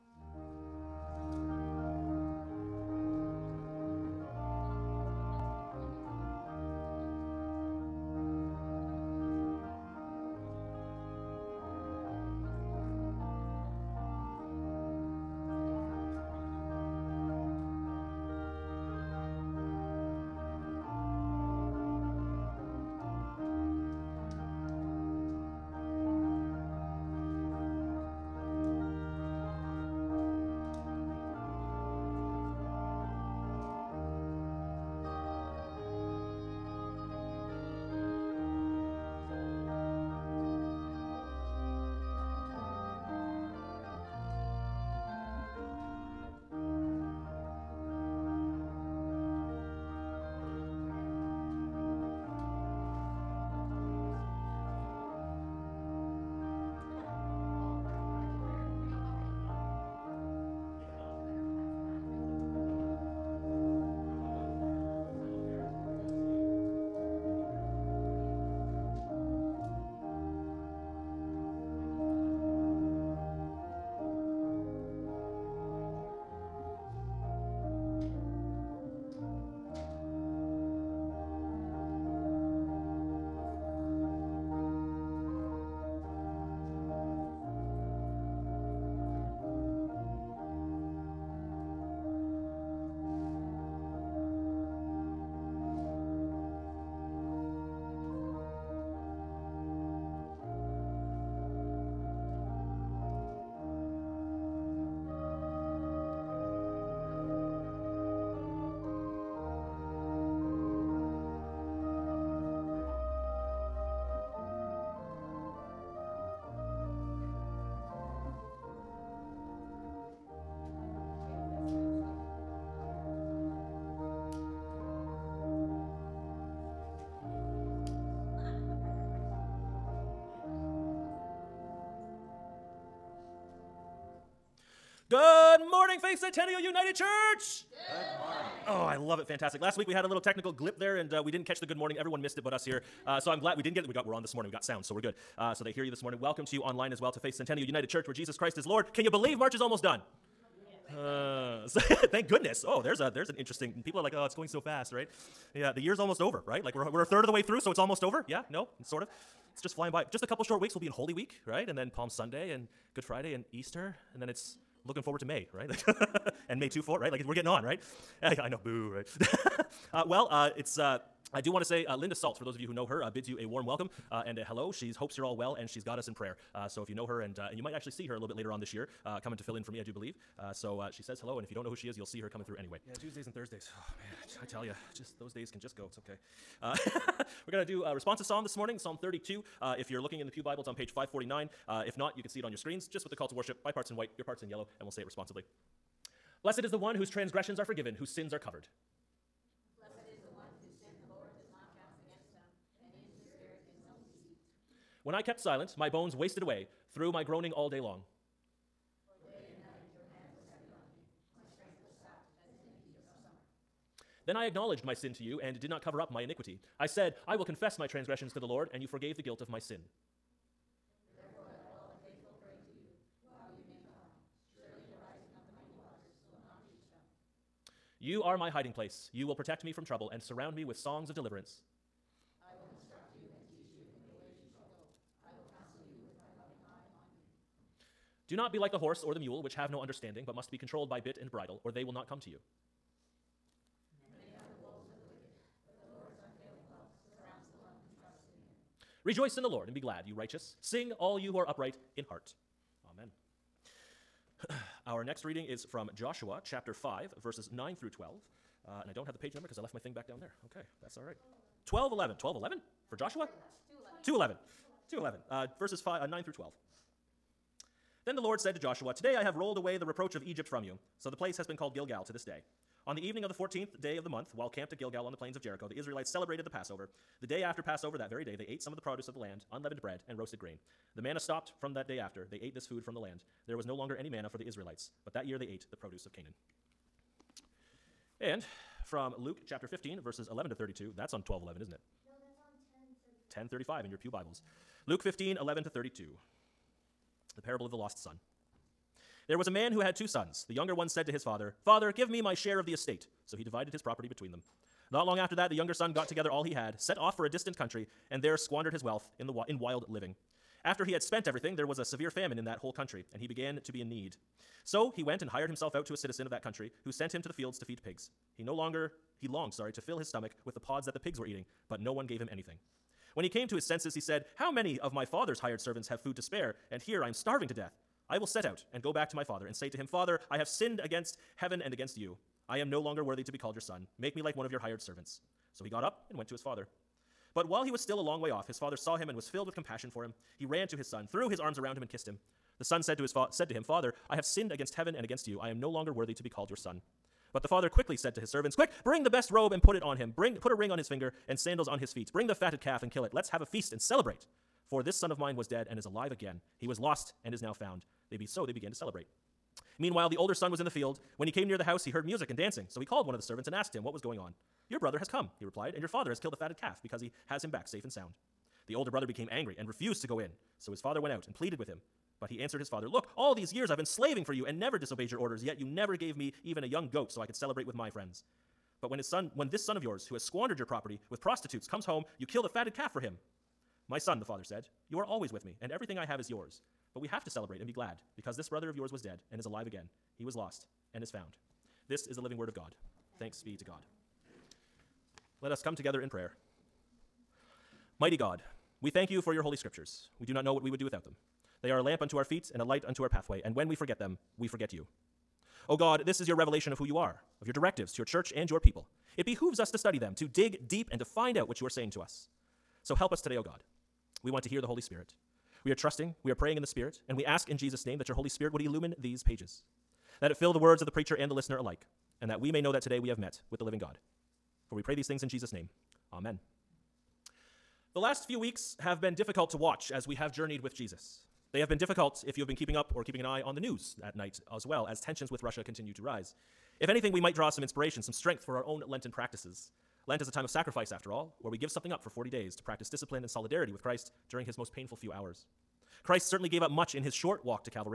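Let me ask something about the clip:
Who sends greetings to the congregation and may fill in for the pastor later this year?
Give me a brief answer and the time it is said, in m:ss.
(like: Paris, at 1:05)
Linda Salt, at 2:51.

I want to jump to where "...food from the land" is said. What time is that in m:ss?
4:42.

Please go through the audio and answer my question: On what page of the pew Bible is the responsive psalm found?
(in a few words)
549.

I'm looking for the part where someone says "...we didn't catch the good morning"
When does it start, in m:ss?
2:21.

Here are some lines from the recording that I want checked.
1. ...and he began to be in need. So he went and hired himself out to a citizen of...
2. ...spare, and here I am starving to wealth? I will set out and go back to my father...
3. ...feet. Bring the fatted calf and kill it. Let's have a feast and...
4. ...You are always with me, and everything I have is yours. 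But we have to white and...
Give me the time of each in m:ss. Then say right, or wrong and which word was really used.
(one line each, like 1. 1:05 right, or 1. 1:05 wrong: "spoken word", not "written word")
1. 5:13 right
2. 5:26 wrong: "death", not "wealth"
3. 5:51 right
4. 6:24 wrong: "celebrate", not "white".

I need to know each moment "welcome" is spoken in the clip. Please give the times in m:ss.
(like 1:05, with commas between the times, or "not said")
2:26, 2:53.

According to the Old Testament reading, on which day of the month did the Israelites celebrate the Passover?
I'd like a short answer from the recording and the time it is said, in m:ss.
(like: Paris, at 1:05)
14th, at 4:33.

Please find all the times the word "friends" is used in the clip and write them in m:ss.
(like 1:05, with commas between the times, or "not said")
6:17.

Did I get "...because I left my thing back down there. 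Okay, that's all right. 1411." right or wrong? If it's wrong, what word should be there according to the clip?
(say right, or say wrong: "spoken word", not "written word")
wrong: "1211", not "1411".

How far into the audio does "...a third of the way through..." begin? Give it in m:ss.
2:37.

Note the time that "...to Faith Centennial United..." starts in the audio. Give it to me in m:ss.
2:27.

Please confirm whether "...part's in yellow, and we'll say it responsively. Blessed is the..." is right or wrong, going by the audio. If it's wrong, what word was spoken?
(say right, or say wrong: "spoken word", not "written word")
right.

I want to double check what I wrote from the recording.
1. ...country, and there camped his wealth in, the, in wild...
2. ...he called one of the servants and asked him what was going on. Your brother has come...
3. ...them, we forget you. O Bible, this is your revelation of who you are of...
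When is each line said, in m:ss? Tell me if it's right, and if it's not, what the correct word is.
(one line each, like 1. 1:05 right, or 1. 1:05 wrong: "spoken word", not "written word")
1. 5:07 wrong: "squandered", not "camped"
2. 6:02 right
3. 6:44 wrong: "God", not "Bible".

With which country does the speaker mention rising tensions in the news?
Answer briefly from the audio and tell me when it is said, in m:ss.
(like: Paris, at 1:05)
Russia, at 7:15.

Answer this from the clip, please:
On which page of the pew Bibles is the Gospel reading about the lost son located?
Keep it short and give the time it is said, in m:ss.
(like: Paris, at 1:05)
1035, at 4:53.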